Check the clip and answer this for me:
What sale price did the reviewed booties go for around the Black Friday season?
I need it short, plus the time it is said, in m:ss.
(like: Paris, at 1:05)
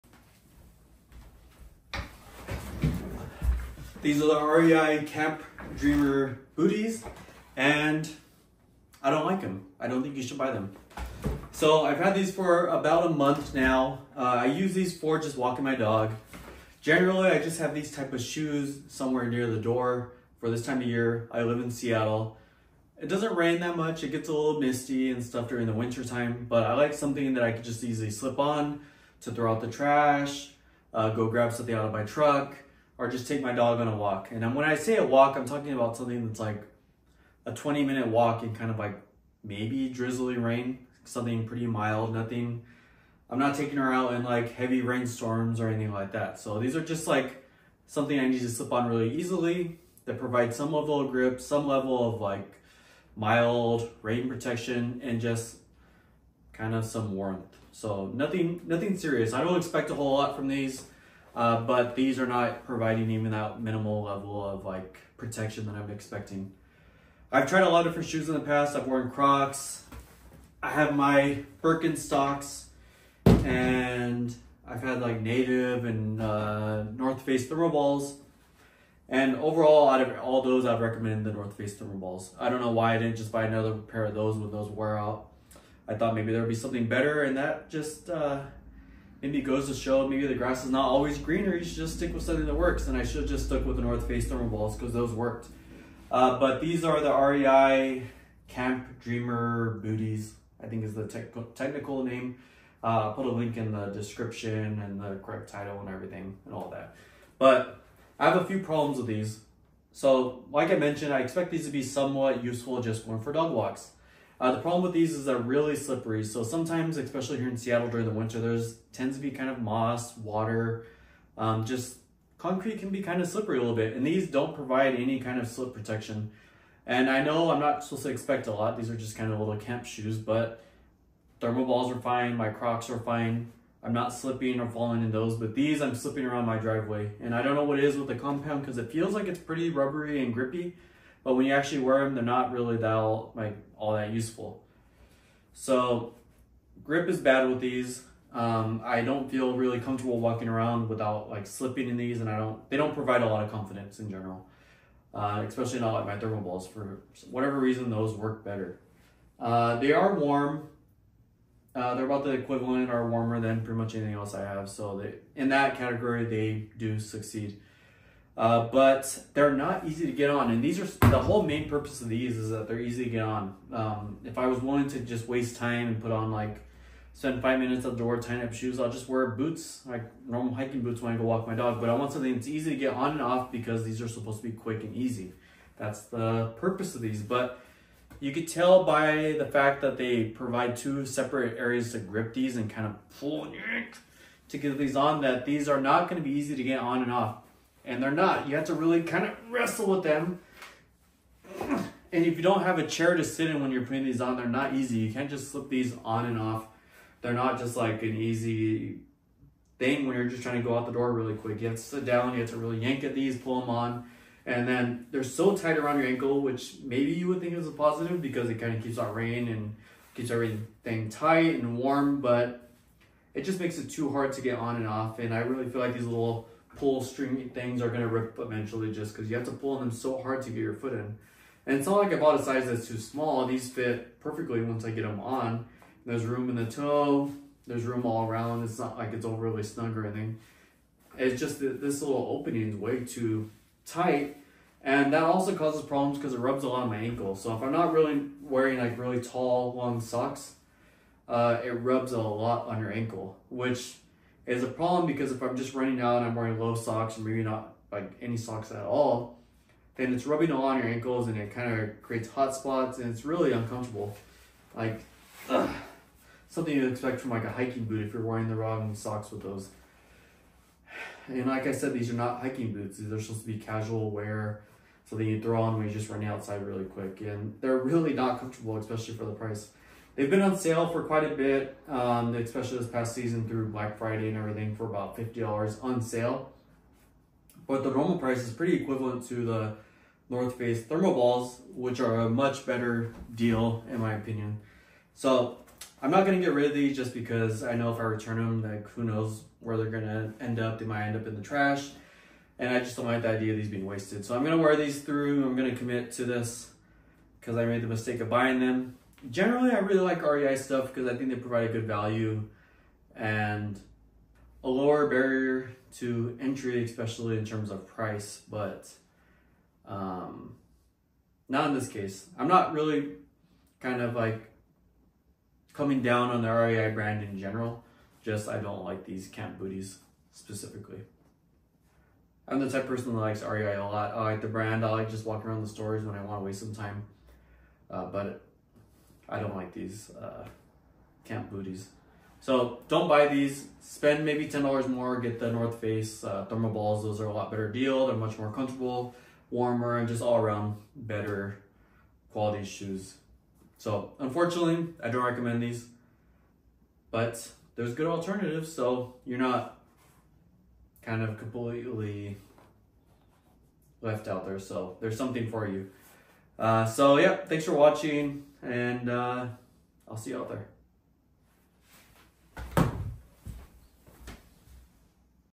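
$50, at 4:45.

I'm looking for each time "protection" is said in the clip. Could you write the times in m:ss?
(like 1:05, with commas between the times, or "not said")
0:54, 1:05, 2:05.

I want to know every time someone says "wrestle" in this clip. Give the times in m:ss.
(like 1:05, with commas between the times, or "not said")
3:19.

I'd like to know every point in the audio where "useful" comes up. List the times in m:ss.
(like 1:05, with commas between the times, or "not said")
1:52, 2:24.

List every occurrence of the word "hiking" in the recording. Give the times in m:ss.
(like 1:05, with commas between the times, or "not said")
3:00, 4:27, 4:32.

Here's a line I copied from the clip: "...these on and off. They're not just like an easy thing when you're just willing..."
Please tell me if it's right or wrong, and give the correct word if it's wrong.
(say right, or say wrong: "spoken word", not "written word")
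wrong: "trying", not "willing".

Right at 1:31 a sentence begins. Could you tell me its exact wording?
You should just stick with something that works.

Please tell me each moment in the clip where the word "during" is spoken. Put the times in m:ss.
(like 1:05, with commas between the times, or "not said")
0:25, 1:57.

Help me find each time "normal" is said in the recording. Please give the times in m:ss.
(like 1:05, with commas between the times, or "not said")
3:00, 4:47.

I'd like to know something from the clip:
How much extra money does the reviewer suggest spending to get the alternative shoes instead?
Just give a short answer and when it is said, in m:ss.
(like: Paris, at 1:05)
$10, at 5:44.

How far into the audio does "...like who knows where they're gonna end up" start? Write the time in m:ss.
4:58.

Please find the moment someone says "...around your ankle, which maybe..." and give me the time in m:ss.
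3:35.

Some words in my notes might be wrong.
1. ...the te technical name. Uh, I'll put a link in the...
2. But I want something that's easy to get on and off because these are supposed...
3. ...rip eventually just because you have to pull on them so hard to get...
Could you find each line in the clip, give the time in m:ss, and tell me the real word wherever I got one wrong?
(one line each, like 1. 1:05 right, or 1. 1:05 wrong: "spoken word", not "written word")
1. 1:40 right
2. 3:01 right
3. 3:48 right.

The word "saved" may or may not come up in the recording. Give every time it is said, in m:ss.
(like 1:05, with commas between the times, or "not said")
not said.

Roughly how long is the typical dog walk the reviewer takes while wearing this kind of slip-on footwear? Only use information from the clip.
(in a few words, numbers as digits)
20 minutes.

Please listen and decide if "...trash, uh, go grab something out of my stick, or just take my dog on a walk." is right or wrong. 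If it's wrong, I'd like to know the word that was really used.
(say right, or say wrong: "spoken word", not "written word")
wrong: "truck", not "stick".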